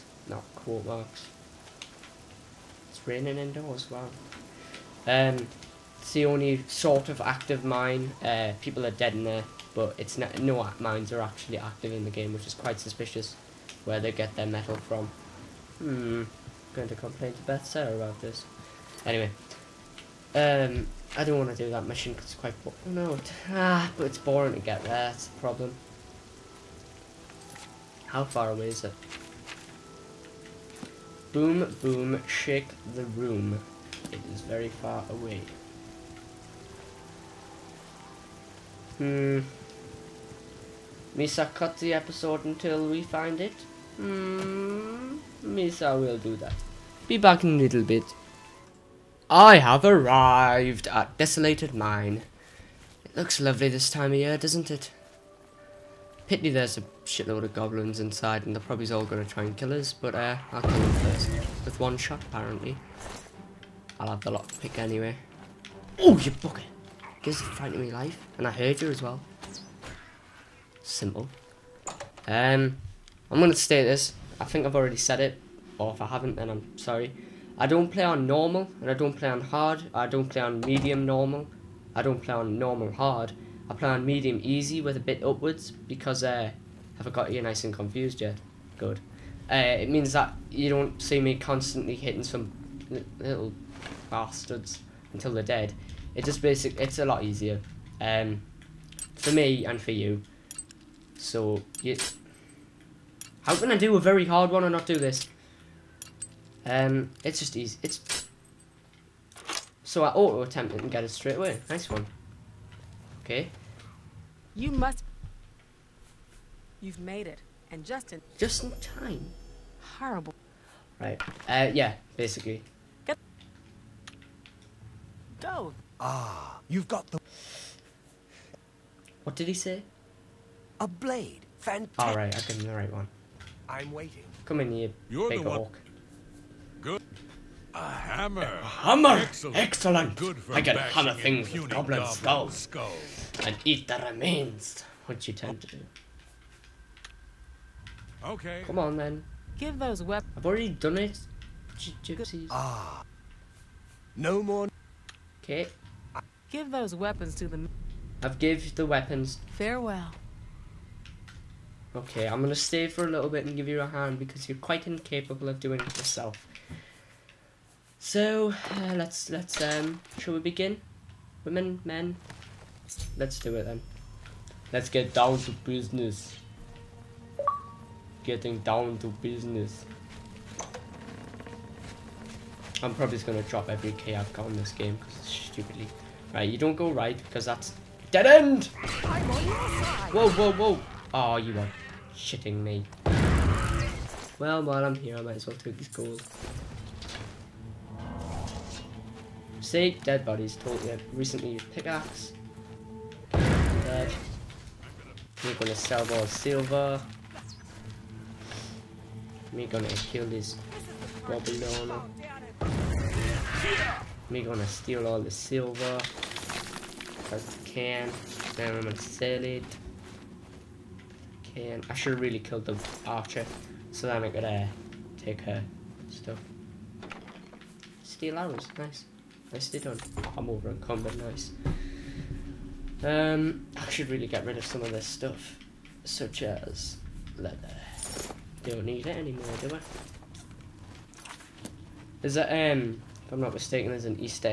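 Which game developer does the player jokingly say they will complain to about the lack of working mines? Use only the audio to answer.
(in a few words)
Bethesda.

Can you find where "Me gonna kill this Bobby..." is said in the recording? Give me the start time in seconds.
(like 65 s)
209 s.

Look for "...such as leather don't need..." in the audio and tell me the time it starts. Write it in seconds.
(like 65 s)
236 s.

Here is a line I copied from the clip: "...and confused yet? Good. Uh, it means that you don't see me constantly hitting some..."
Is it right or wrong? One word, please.
right.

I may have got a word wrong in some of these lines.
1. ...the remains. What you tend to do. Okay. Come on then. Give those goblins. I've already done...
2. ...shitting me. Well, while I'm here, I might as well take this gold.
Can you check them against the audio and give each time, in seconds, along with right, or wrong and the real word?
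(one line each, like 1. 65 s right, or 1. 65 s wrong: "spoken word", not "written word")
1. 143 s wrong: "weapons", not "goblins"
2. 192 s right.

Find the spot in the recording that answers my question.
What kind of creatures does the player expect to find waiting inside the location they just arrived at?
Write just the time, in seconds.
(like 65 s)
57 s.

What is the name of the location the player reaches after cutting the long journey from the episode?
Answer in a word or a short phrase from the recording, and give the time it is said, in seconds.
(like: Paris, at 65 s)
Desolated Mine, at 51 s.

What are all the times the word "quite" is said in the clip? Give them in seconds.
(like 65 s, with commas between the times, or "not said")
12 s, 22 s, 164 s.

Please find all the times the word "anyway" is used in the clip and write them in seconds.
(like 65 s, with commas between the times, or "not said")
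19 s, 64 s.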